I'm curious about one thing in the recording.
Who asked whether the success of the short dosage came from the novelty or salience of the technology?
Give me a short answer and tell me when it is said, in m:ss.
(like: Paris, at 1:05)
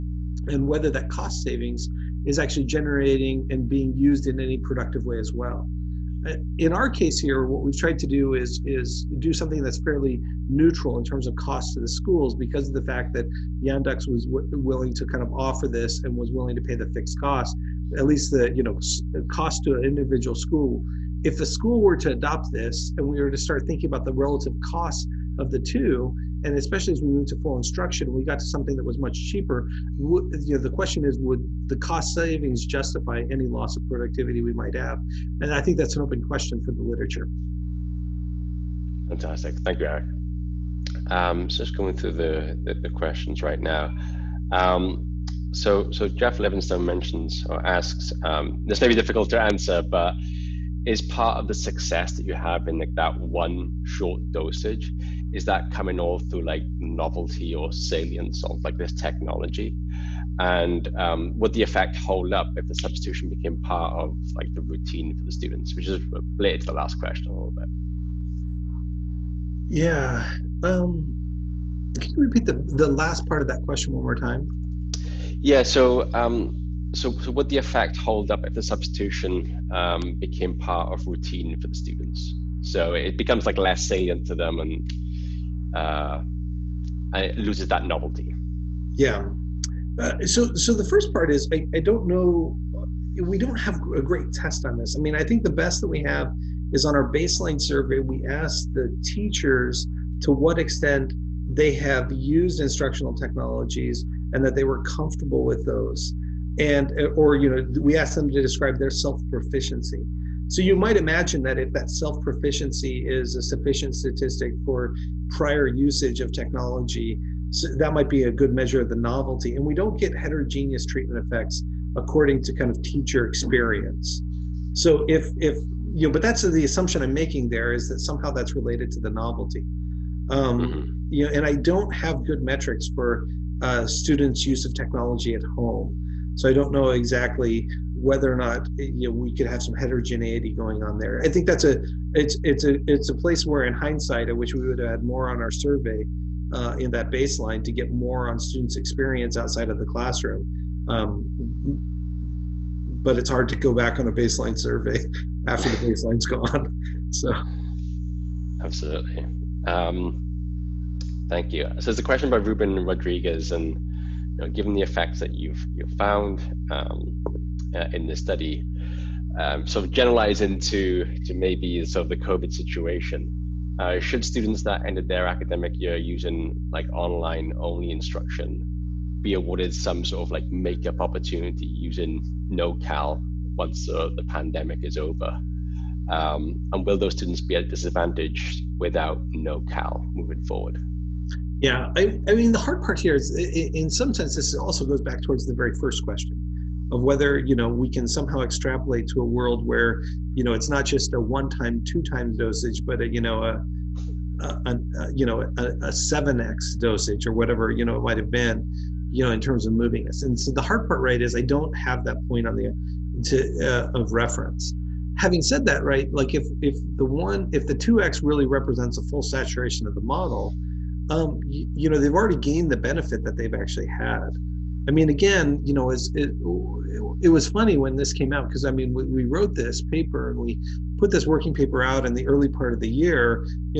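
Jeff Levinstone, at 0:46.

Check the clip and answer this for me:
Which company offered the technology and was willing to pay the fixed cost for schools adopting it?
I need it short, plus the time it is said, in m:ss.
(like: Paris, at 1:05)
Yandex, at 0:13.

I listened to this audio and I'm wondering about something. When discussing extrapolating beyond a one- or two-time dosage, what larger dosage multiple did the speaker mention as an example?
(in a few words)
7x.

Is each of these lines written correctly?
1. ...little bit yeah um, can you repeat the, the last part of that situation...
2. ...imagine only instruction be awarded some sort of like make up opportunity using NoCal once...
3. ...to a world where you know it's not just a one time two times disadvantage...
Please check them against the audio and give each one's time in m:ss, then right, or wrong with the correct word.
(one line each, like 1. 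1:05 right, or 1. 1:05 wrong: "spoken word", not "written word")
1. 1:07 wrong: "question", not "situation"
2. 2:56 wrong: "online", not "imagine"
3. 3:19 wrong: "dosage", not "disadvantage".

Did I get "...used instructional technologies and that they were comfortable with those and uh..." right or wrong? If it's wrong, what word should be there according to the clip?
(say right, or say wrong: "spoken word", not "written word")
right.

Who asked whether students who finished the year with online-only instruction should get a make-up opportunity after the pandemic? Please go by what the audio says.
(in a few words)
Ruben Rodriguez.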